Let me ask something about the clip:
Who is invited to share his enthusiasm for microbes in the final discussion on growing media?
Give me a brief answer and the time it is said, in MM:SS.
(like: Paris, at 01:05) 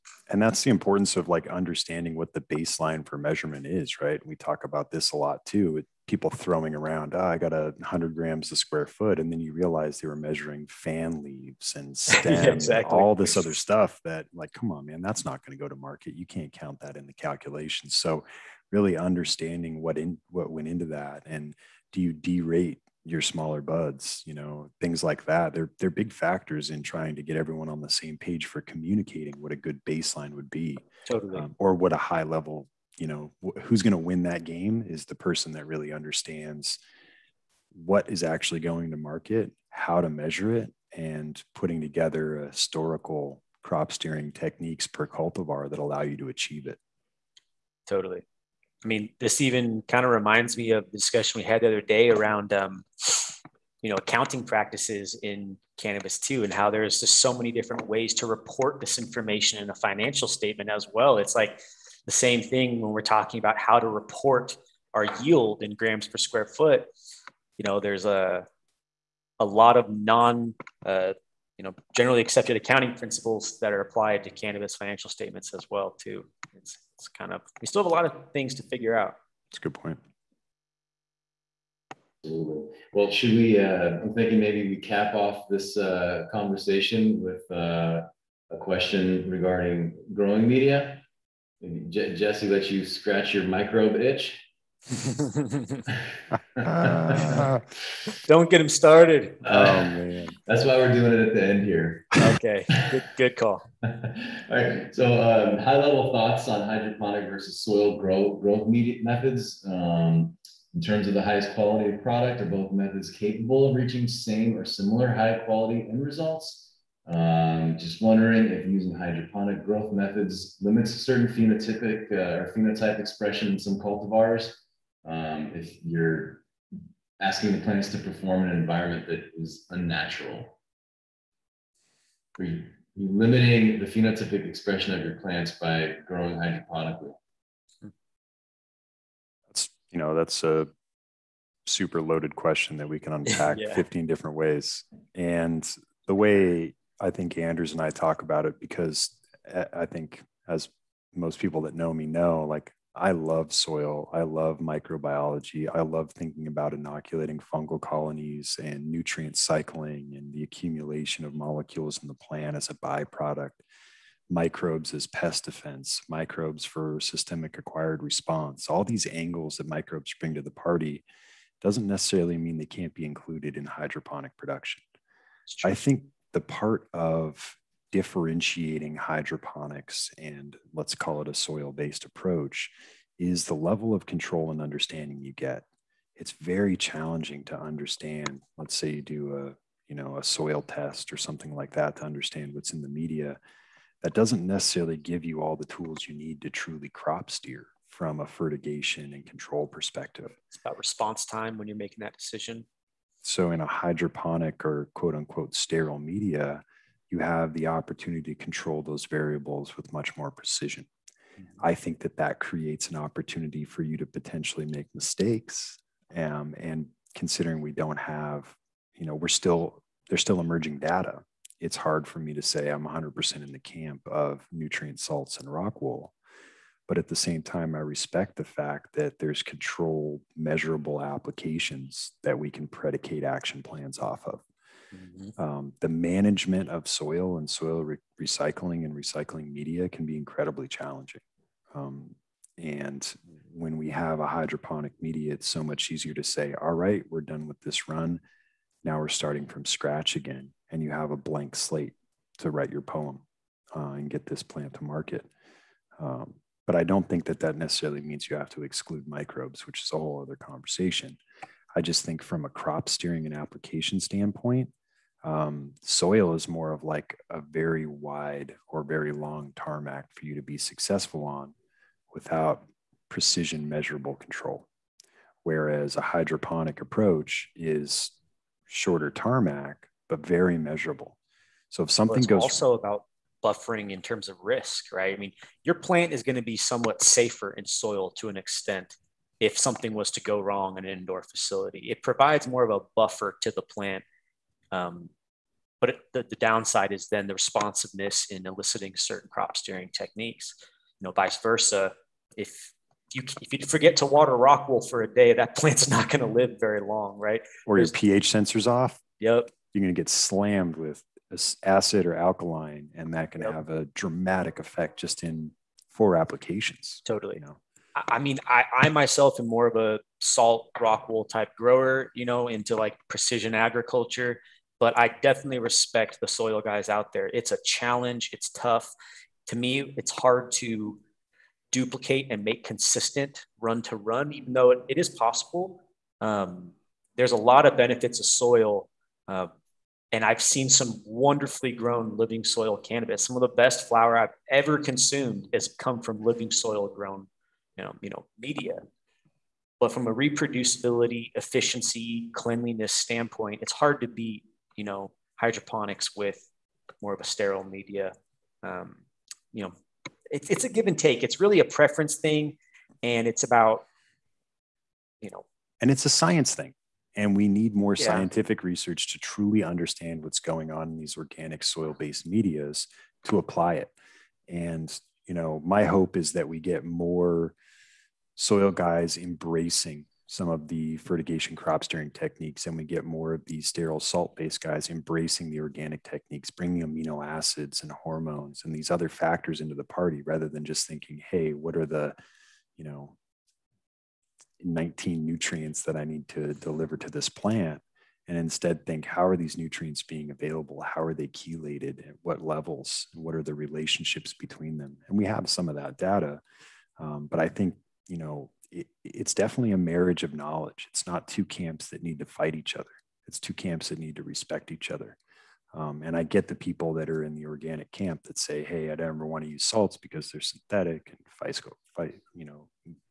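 Jesse, at 01:31.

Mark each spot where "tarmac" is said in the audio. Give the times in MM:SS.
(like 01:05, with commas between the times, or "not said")
04:29, 04:39.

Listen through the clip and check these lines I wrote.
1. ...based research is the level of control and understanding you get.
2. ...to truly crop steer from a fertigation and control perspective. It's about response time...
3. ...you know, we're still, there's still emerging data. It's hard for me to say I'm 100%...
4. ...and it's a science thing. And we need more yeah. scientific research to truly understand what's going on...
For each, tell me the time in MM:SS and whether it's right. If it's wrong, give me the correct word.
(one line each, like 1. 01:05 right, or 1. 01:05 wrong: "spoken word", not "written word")
1. 03:01 wrong: "approach", not "research"
2. 03:16 right
3. 03:38 right
4. 06:05 right.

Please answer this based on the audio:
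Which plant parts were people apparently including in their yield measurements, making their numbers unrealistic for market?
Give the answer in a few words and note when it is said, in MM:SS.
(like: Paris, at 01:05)
fan leaves and stems, at 00:10.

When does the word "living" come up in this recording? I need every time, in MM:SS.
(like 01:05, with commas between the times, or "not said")
05:42, 05:46.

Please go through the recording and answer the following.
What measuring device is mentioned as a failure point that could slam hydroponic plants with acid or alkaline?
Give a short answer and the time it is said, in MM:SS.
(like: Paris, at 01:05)
pH sensor, at 05:07.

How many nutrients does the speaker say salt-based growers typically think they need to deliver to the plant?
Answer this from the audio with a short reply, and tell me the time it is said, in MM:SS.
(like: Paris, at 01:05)
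19, at 06:34.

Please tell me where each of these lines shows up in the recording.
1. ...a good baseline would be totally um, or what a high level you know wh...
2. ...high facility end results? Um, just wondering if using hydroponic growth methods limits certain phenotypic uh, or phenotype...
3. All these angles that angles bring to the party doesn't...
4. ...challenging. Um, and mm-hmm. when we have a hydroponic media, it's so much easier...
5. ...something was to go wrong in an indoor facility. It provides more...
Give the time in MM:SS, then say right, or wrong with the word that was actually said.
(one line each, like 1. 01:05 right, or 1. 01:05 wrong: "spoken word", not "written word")
1. 00:29 right
2. 01:55 wrong: "quality", not "facility"
3. 02:48 wrong: "microbes", not "angles"
4. 04:00 right
5. 04:49 right.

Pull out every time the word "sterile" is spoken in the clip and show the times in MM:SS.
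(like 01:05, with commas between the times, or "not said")
03:25, 05:57, 06:23.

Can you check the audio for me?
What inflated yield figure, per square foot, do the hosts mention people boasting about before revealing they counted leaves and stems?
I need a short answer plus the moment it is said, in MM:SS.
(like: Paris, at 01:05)
100 grams, at 00:07.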